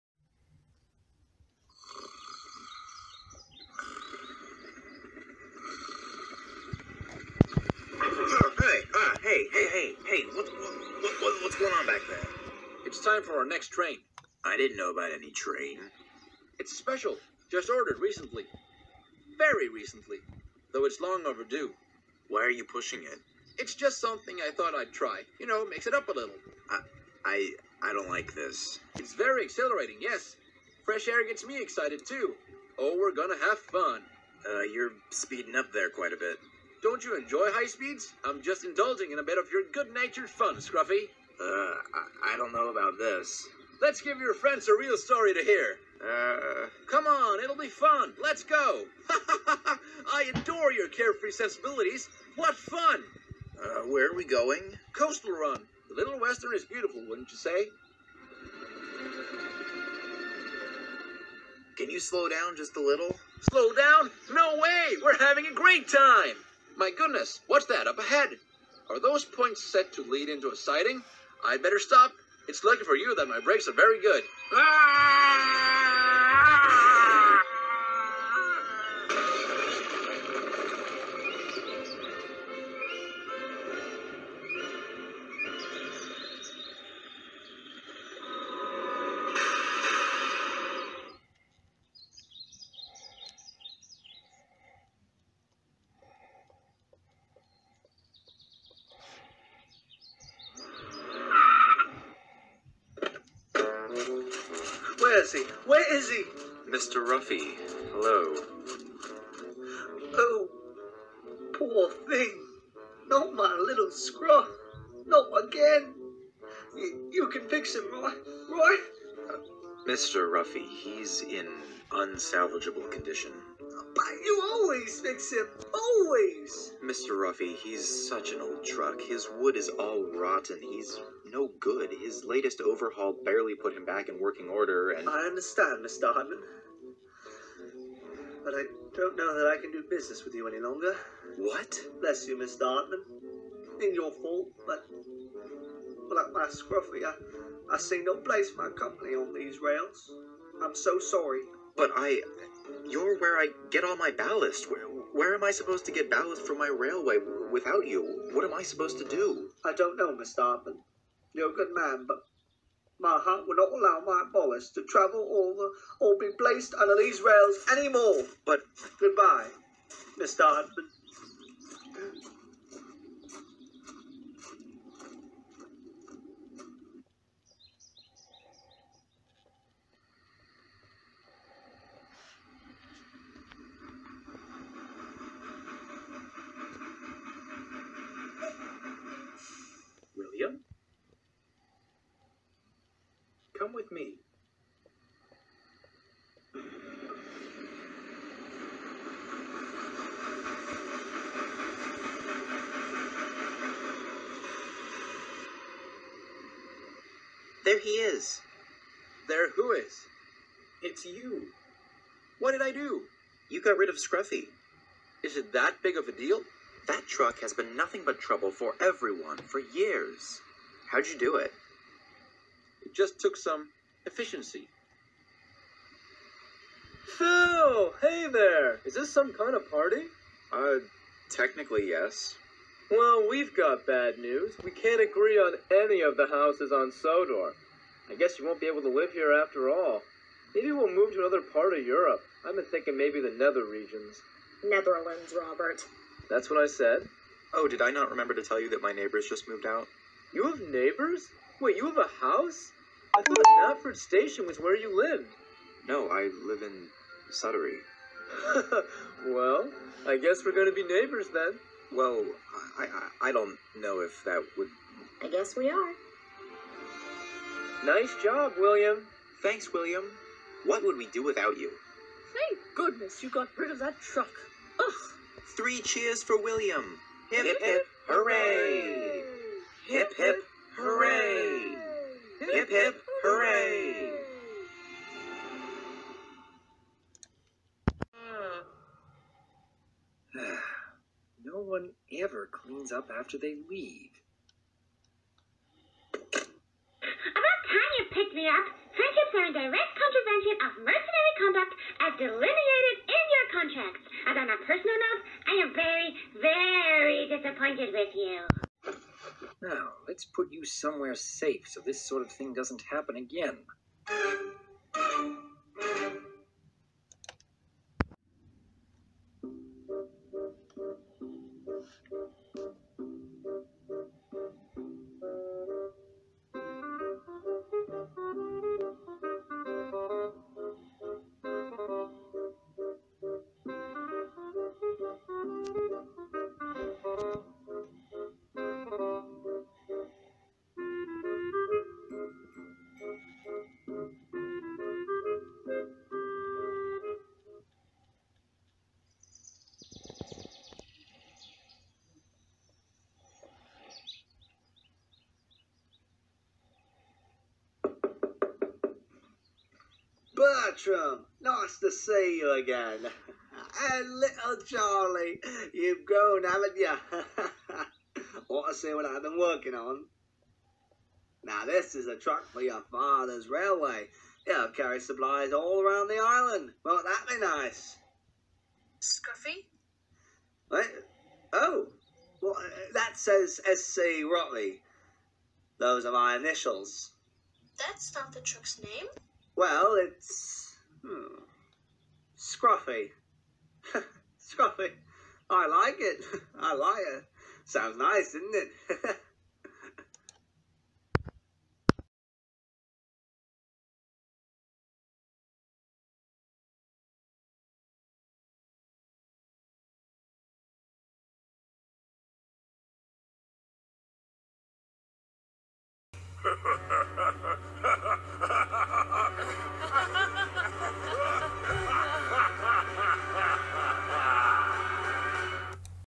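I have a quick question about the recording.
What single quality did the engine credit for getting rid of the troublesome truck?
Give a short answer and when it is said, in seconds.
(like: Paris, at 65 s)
Efficiency, at 224 s.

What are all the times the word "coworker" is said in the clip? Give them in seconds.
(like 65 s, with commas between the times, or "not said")
not said.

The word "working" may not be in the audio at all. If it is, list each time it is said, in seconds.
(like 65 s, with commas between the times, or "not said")
134 s, 369 s.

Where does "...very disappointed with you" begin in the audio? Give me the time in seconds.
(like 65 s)
306 s.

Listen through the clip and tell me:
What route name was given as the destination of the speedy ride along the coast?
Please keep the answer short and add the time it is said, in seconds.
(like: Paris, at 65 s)
Coastal Run, at 54 s.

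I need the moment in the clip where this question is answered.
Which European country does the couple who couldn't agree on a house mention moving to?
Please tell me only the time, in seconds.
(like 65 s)
244 s.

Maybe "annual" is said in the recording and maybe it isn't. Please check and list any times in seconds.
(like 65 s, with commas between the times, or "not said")
not said.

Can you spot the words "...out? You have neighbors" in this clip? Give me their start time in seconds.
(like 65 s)
249 s.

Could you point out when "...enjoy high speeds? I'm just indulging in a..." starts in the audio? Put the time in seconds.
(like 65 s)
37 s.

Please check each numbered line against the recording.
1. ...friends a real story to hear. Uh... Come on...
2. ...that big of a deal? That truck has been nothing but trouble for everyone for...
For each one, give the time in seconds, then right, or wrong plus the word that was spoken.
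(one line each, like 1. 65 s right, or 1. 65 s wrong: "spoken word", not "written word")
1. 44 s right
2. 215 s right.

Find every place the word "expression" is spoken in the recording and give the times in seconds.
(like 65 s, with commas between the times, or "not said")
not said.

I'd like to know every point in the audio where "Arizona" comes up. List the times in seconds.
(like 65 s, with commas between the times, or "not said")
not said.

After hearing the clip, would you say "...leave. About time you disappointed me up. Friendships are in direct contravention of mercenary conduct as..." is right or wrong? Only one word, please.
wrong.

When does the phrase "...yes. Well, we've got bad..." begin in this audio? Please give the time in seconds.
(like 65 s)
231 s.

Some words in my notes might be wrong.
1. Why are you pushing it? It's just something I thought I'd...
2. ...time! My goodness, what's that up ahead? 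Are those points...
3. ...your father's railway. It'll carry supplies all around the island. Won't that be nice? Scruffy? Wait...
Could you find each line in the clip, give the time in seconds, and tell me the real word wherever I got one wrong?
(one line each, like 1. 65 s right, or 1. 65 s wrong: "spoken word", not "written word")
1. 22 s right
2. 65 s right
3. 372 s right.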